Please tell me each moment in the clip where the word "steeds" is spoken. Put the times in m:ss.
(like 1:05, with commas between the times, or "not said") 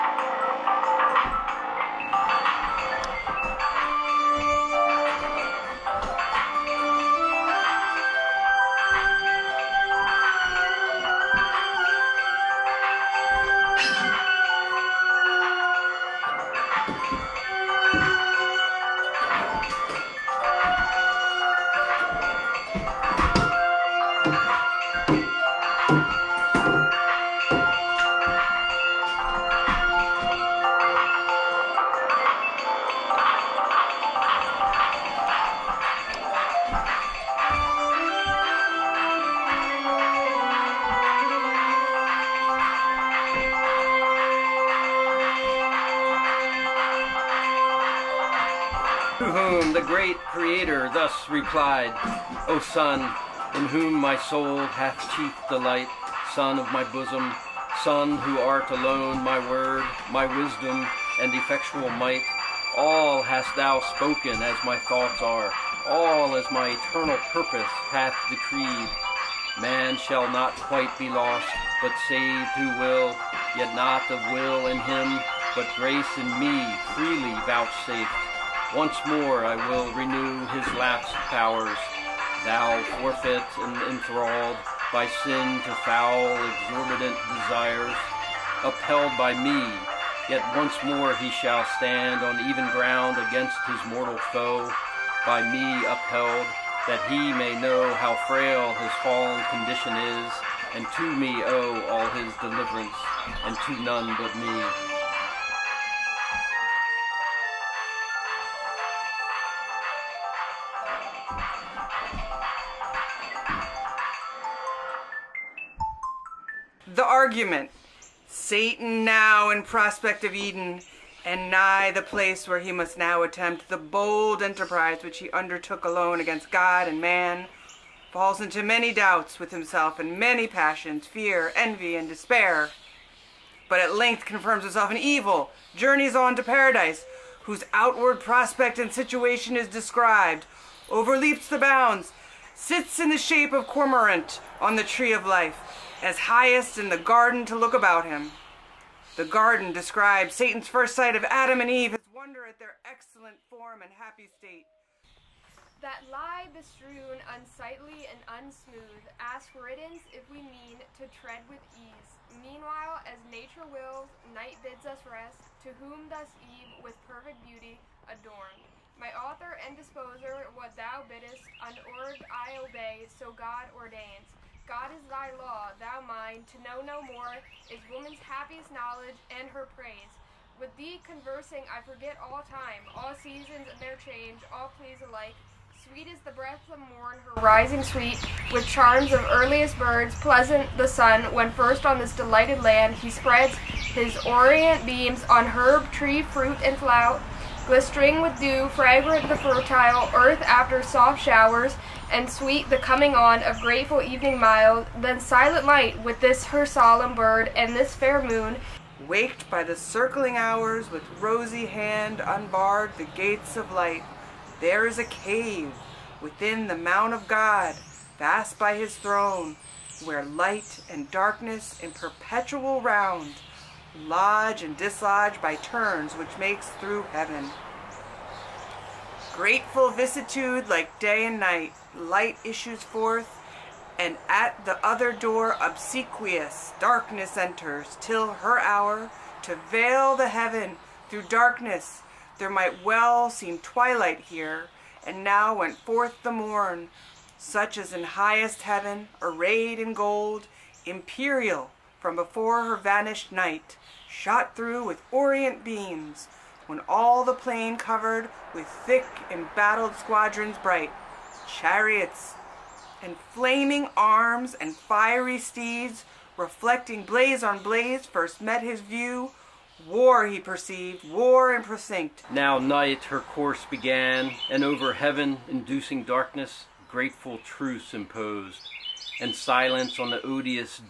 4:25.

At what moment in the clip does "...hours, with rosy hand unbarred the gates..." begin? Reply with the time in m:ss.
3:30.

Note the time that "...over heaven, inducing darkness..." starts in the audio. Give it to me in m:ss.
4:34.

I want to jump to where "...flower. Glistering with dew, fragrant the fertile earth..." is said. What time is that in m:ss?
3:16.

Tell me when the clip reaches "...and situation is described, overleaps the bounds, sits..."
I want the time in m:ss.
2:18.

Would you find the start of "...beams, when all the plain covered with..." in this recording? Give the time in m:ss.
4:15.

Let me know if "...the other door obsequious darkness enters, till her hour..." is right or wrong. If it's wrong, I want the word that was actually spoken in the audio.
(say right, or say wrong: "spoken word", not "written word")
right.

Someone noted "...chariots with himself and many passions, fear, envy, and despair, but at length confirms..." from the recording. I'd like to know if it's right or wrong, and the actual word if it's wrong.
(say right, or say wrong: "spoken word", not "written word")
wrong: "doubts", not "chariots".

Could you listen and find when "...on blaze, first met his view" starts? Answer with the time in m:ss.
4:27.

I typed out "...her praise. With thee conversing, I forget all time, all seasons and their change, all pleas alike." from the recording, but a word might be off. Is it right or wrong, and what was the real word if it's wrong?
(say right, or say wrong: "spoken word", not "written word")
right.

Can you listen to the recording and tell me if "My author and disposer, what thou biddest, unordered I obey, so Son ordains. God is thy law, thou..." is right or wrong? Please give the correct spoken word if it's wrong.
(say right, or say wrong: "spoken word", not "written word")
wrong: "God", not "Son".